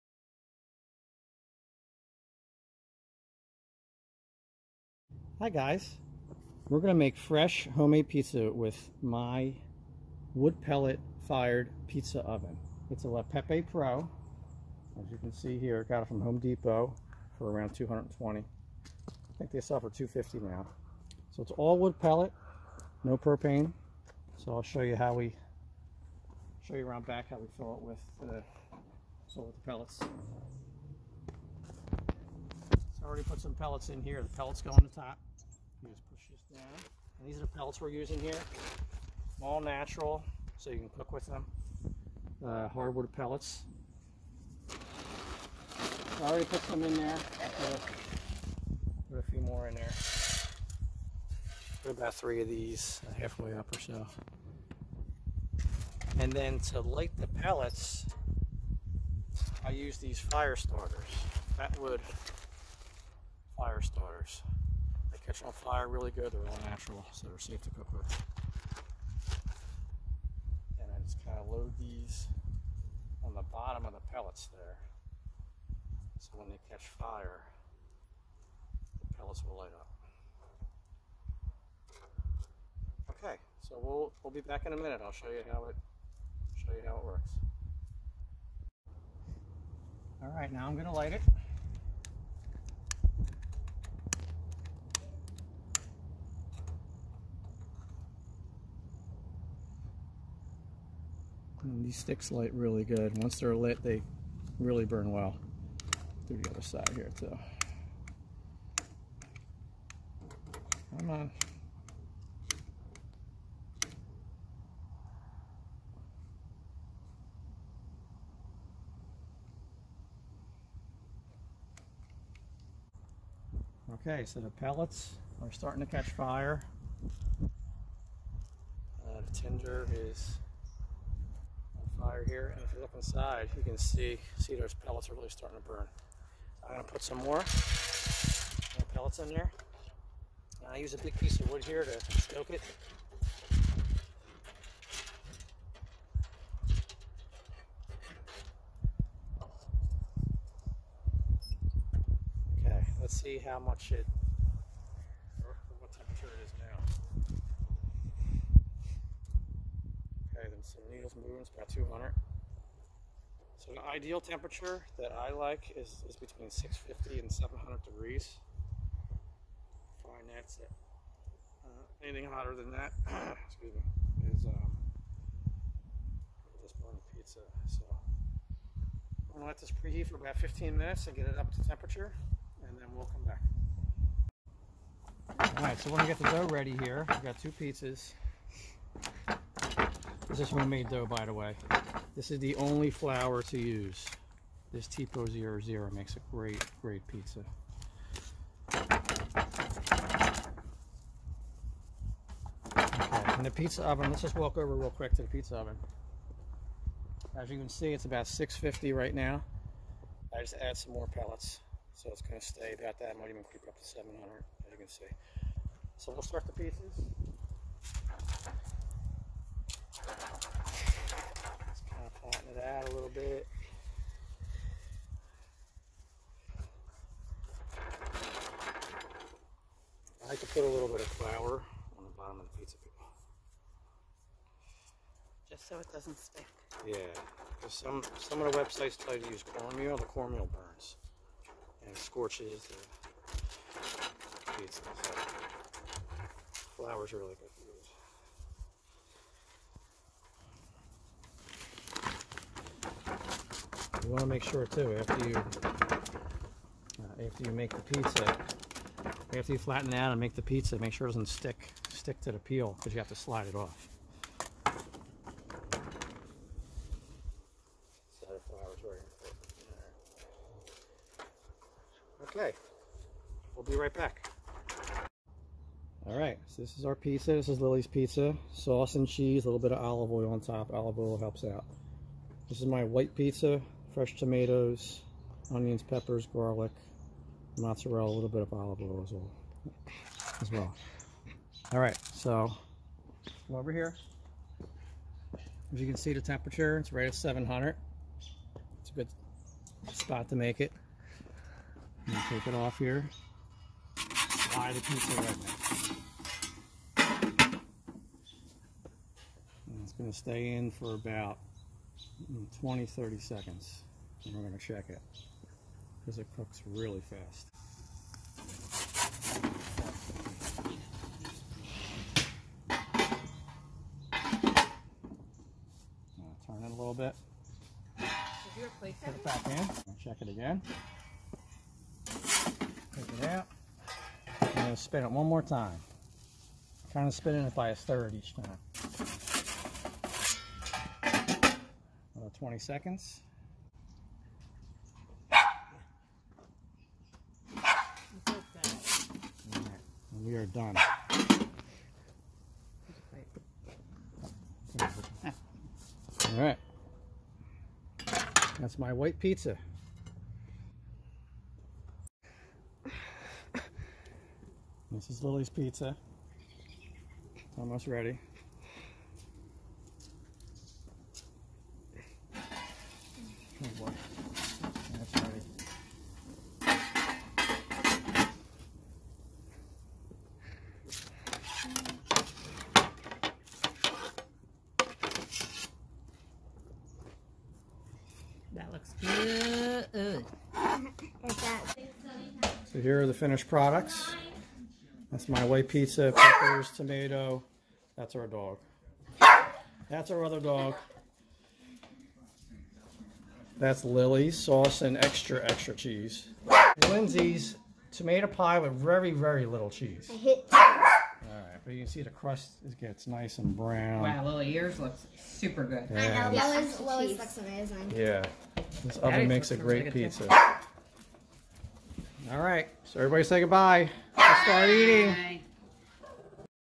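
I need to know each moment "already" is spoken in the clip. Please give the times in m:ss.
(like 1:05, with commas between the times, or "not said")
0:33, 0:46.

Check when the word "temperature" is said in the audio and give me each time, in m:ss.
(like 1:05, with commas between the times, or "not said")
2:44, 3:01, 4:56.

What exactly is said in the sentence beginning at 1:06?
They're all natural, so they're safe to cook with.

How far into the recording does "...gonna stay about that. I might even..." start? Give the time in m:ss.
3:32.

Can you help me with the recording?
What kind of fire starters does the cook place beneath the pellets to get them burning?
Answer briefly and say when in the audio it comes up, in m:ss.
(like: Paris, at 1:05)
Fatwood, at 1:01.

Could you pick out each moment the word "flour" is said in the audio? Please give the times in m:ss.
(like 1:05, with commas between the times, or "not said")
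3:12, 3:51.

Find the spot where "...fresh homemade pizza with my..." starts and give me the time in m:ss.
0:07.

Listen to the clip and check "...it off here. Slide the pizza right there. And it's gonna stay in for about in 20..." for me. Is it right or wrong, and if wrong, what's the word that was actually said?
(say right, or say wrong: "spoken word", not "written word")
right.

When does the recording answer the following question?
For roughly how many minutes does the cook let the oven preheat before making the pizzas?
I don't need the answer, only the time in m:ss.
3:00.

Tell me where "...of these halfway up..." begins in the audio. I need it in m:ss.
0:52.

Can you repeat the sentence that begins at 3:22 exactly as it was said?
Okay, in the pizza oven, let's just walk over real quick to the pizza oven.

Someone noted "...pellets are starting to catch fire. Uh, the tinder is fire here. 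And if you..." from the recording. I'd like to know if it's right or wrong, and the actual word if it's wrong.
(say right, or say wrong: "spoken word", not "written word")
right.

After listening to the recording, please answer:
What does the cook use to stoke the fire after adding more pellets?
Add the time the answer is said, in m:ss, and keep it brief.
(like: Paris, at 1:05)
a big piece of wood, at 2:20.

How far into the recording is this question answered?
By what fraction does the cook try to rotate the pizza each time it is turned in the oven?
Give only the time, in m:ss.
5:37.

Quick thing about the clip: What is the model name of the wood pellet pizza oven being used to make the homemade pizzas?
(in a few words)
La Peppe Pro.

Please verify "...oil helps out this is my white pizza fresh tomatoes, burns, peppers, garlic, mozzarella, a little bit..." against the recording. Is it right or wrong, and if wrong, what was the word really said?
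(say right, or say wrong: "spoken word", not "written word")
wrong: "onions", not "burns".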